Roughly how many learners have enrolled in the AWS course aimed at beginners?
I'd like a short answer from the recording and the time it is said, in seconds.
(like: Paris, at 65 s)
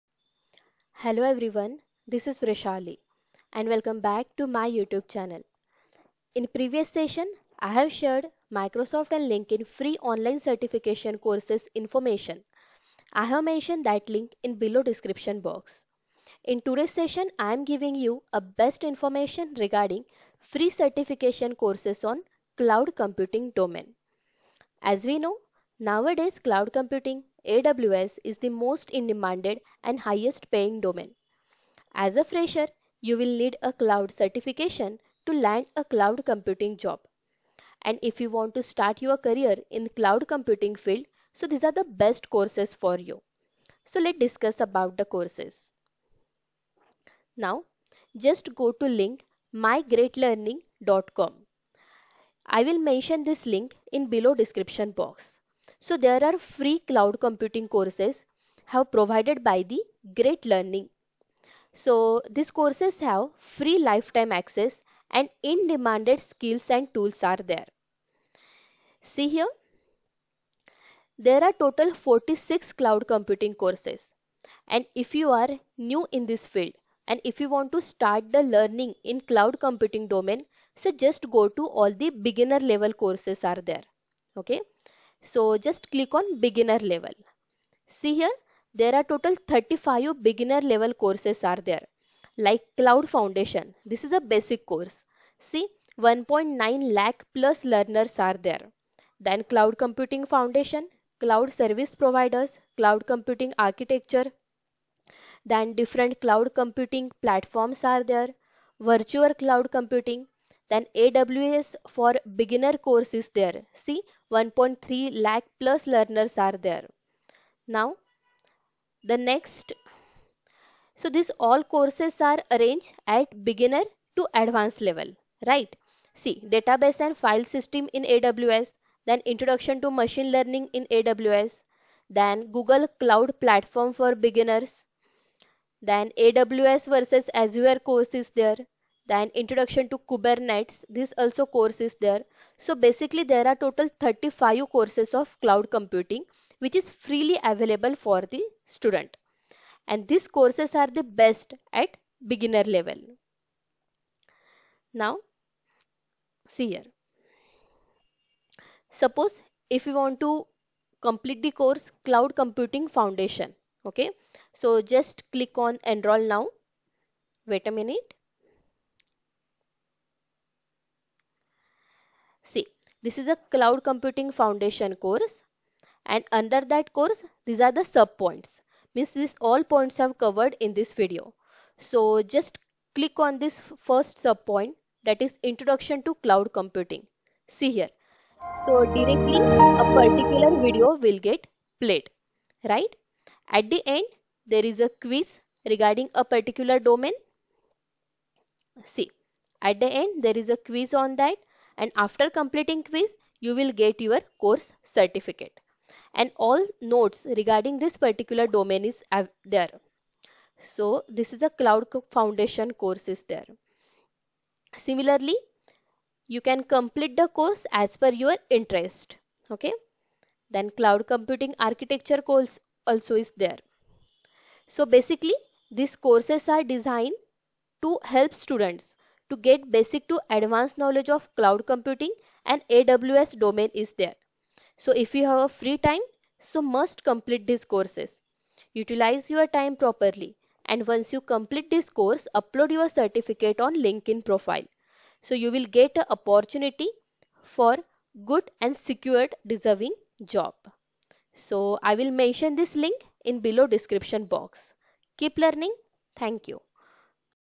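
1.3 lakh plus, at 114 s.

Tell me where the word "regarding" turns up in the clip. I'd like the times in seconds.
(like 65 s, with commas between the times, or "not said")
19 s, 195 s, 207 s.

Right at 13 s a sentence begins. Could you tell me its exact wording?
I have mentioned that link in below description box.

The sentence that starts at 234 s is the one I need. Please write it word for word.
So if you have a free time, so must complete these courses.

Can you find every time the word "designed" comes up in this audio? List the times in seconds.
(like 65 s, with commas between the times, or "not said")
226 s.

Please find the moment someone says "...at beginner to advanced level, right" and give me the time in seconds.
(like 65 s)
123 s.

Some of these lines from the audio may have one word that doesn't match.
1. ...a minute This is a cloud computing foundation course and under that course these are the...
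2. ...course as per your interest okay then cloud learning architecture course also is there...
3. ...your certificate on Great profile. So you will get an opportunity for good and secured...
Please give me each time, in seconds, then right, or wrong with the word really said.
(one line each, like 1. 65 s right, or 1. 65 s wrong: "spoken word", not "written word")
1. 167 s right
2. 217 s wrong: "computing", not "learning"
3. 242 s wrong: "LinkedIn", not "Great".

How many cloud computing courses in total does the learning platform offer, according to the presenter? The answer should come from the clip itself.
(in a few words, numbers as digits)
46.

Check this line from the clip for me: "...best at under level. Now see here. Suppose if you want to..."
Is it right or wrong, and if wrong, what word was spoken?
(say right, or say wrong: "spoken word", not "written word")
wrong: "beginner", not "under".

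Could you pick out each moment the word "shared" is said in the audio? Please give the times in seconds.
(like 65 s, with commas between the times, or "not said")
7 s.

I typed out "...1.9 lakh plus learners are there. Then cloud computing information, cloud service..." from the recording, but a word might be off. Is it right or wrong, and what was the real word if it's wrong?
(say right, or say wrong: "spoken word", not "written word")
wrong: "foundation", not "information".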